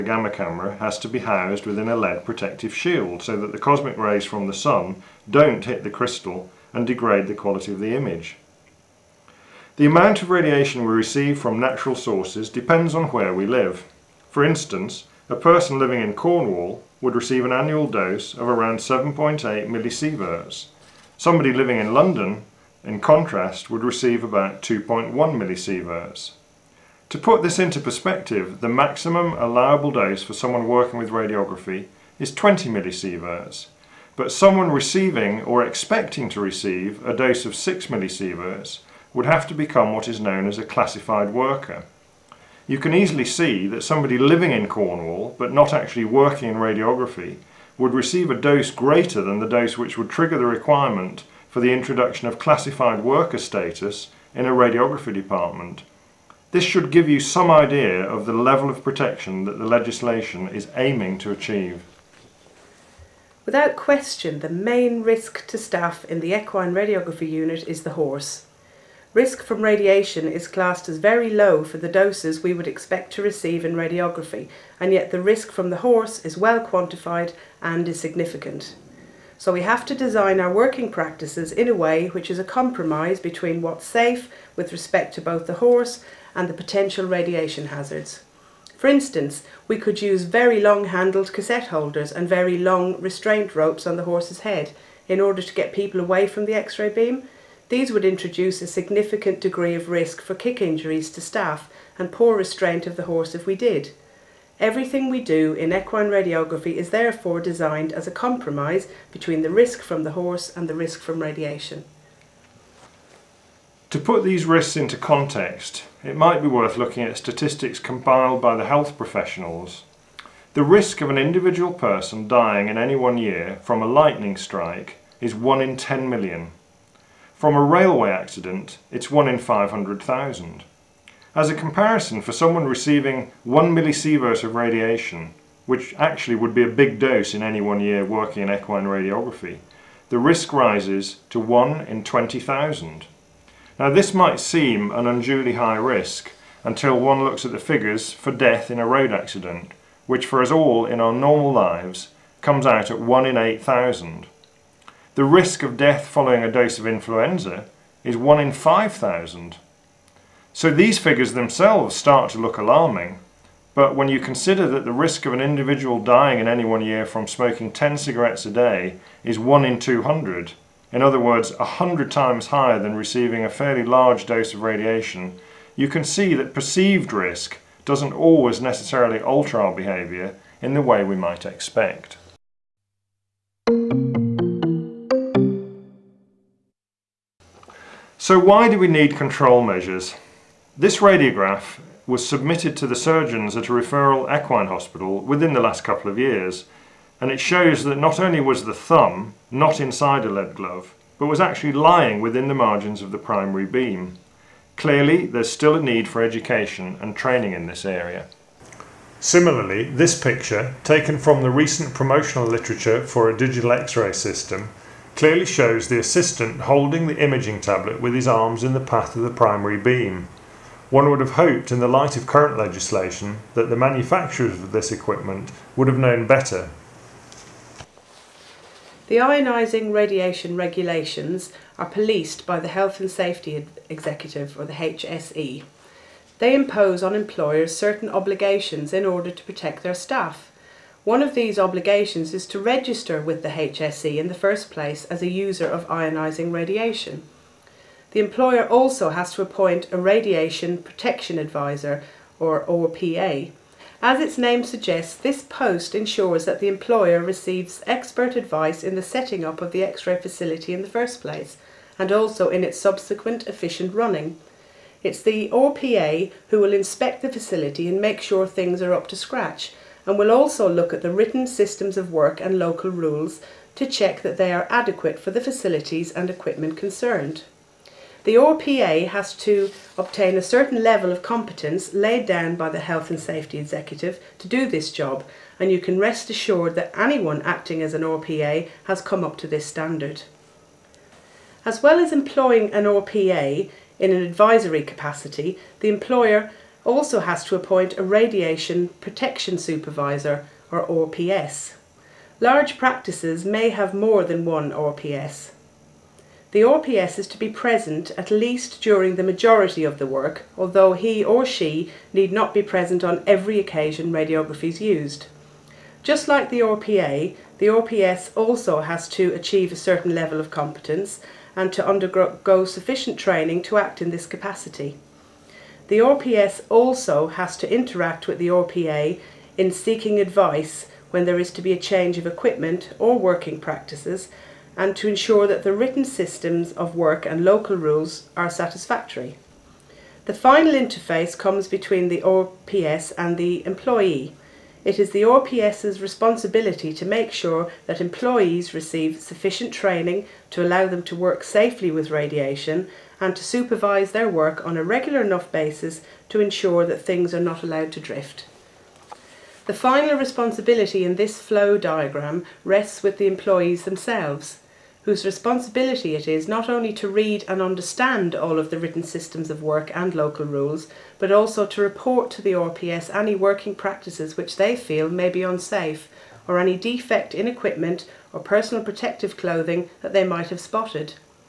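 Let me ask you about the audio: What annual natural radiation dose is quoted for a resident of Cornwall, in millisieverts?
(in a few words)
7.8 millisieverts.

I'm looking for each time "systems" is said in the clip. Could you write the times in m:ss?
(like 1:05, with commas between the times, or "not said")
3:34, 4:31, 5:36, 6:09.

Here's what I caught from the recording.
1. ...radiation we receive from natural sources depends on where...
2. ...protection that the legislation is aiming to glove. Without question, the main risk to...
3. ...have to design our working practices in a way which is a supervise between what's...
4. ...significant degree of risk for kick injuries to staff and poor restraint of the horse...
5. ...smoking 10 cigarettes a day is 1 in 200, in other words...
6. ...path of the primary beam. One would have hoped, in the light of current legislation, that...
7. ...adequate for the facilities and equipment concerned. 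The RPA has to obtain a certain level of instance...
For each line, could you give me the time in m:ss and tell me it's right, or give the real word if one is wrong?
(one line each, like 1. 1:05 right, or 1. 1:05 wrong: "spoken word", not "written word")
1. 0:10 right
2. 0:58 wrong: "achieve", not "glove"
3. 1:19 wrong: "compromise", not "supervise"
4. 1:38 right
5. 2:47 right
6. 3:38 right
7. 4:34 wrong: "competence", not "instance".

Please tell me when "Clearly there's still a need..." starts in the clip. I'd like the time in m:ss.
3:24.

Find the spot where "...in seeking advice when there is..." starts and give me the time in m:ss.
5:29.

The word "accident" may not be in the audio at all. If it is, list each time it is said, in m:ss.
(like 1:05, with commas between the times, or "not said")
2:08, 2:29.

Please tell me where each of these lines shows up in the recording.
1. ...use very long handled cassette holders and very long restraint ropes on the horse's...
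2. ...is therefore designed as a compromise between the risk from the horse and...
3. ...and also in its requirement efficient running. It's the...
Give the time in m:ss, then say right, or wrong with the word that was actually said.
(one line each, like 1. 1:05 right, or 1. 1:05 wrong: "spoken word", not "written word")
1. 1:30 right
2. 1:46 right
3. 4:21 wrong: "subsequent", not "requirement".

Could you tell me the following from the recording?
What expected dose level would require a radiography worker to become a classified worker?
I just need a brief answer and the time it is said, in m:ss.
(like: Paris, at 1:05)
6 millisieverts, at 0:37.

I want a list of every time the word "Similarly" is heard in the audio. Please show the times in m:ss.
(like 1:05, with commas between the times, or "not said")
3:29.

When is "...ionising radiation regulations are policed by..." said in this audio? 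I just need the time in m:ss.
3:49.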